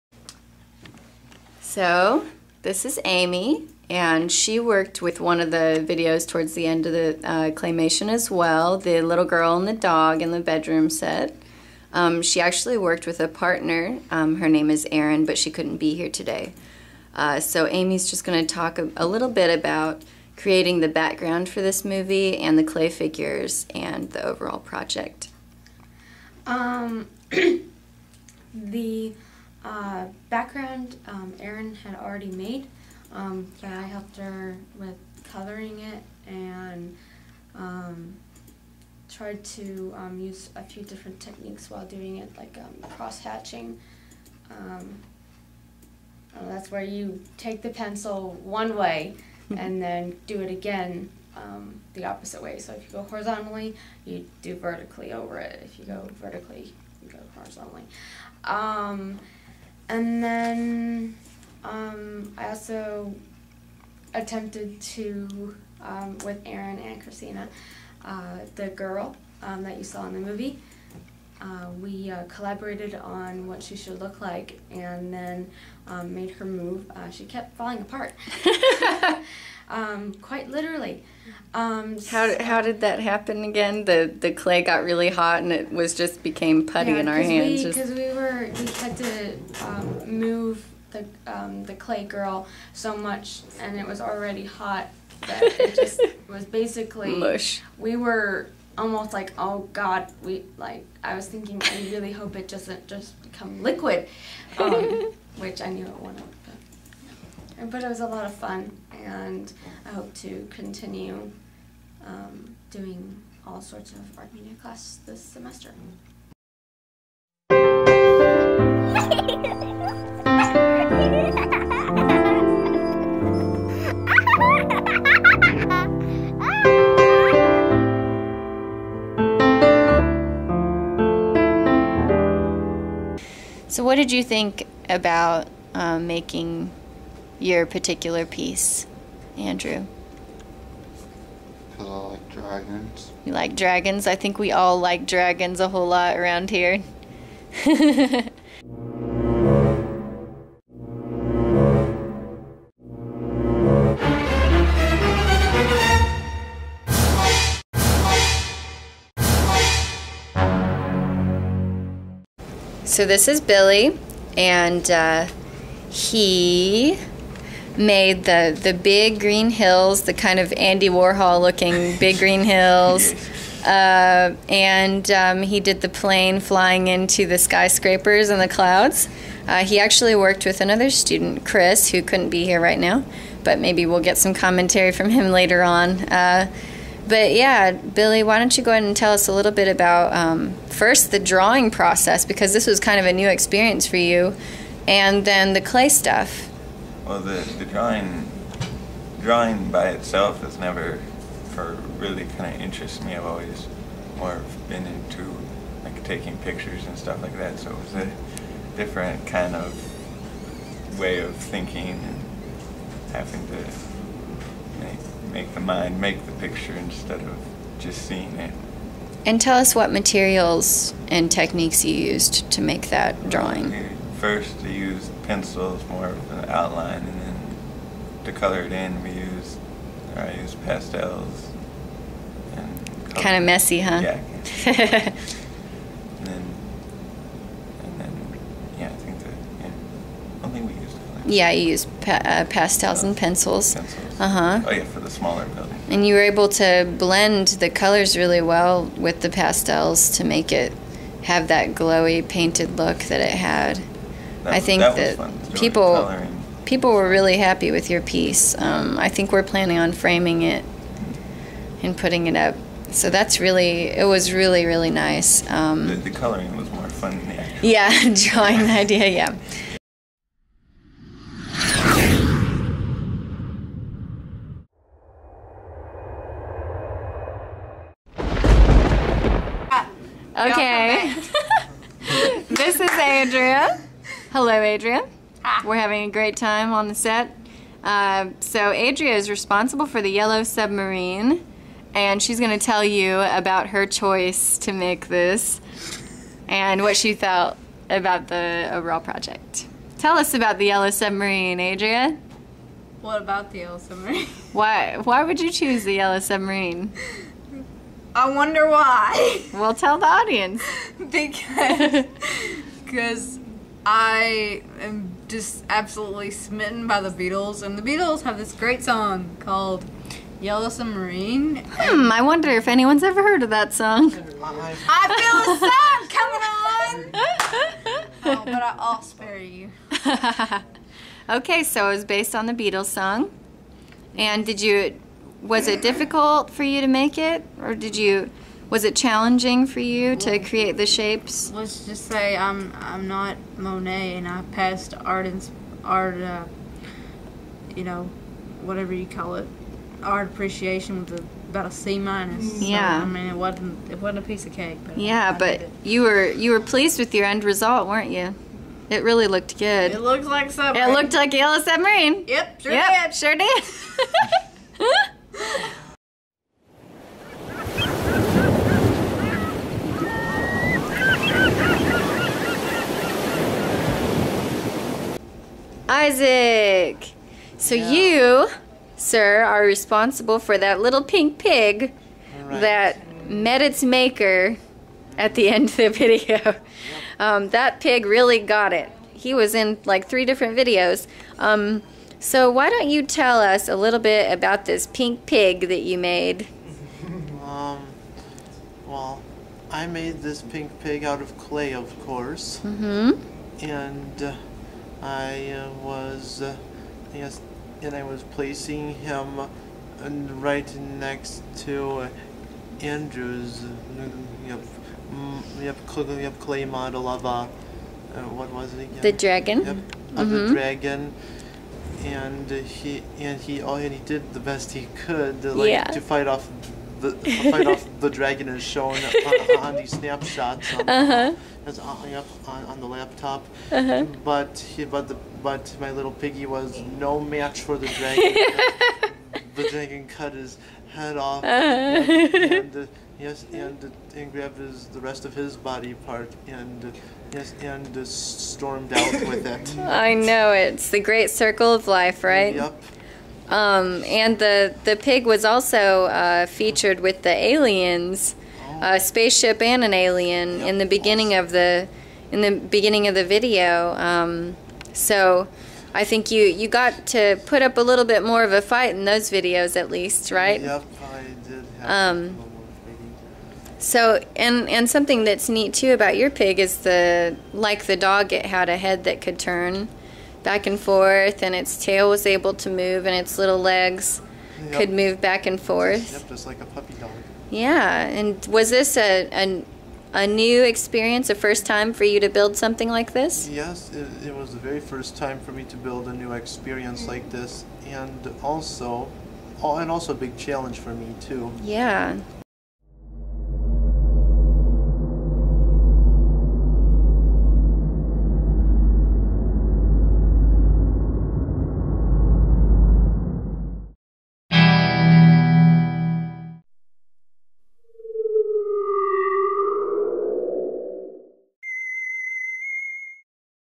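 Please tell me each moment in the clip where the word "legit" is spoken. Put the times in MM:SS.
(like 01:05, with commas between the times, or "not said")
not said.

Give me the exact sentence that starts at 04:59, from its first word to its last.
Tell us about the Yellow Submarine, Adria.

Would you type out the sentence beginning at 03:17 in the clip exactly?
Well, the, the drawing drawing by itself has never, for really kind of interests me.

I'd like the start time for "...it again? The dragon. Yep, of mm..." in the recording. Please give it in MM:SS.
06:58.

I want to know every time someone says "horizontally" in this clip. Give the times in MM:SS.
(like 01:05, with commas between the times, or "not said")
00:53, 00:57.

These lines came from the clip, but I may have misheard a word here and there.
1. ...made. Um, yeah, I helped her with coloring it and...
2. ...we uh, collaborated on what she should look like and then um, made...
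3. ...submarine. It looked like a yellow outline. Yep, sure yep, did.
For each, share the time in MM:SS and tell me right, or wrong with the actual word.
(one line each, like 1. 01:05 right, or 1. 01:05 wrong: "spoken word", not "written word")
1. 00:32 right
2. 01:11 right
3. 06:00 wrong: "submarine", not "outline".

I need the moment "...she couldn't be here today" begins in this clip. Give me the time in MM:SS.
00:15.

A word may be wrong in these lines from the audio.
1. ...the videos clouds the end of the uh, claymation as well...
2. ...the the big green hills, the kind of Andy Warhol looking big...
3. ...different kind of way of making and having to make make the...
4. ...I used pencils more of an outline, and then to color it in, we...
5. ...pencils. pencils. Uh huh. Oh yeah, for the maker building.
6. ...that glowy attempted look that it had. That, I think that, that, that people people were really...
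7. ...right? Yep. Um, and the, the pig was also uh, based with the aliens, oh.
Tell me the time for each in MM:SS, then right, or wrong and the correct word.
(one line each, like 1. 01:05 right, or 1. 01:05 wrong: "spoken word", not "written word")
1. 00:05 wrong: "towards", not "clouds"
2. 02:48 right
3. 03:28 wrong: "thinking", not "making"
4. 03:44 right
5. 04:03 wrong: "smaller", not "maker"
6. 04:11 wrong: "painted", not "attempted"
7. 07:32 wrong: "featured", not "based".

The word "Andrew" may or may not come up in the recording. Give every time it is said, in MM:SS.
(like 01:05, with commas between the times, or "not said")
02:19, 06:52.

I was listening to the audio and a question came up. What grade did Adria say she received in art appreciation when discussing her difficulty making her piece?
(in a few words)
C minus.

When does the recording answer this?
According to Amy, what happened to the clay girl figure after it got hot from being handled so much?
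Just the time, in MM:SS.
01:26.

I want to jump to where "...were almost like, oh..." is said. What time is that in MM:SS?
01:37.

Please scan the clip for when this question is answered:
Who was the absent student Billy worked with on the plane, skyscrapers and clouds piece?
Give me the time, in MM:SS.
03:01.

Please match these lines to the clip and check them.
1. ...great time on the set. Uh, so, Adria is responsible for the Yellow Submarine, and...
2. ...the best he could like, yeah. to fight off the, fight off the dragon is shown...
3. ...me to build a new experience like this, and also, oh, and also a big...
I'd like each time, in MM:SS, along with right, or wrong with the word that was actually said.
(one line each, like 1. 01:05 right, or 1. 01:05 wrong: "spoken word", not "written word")
1. 04:46 right
2. 07:04 right
3. 08:15 right.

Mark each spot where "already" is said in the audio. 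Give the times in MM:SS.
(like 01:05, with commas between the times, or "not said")
00:31, 01:34.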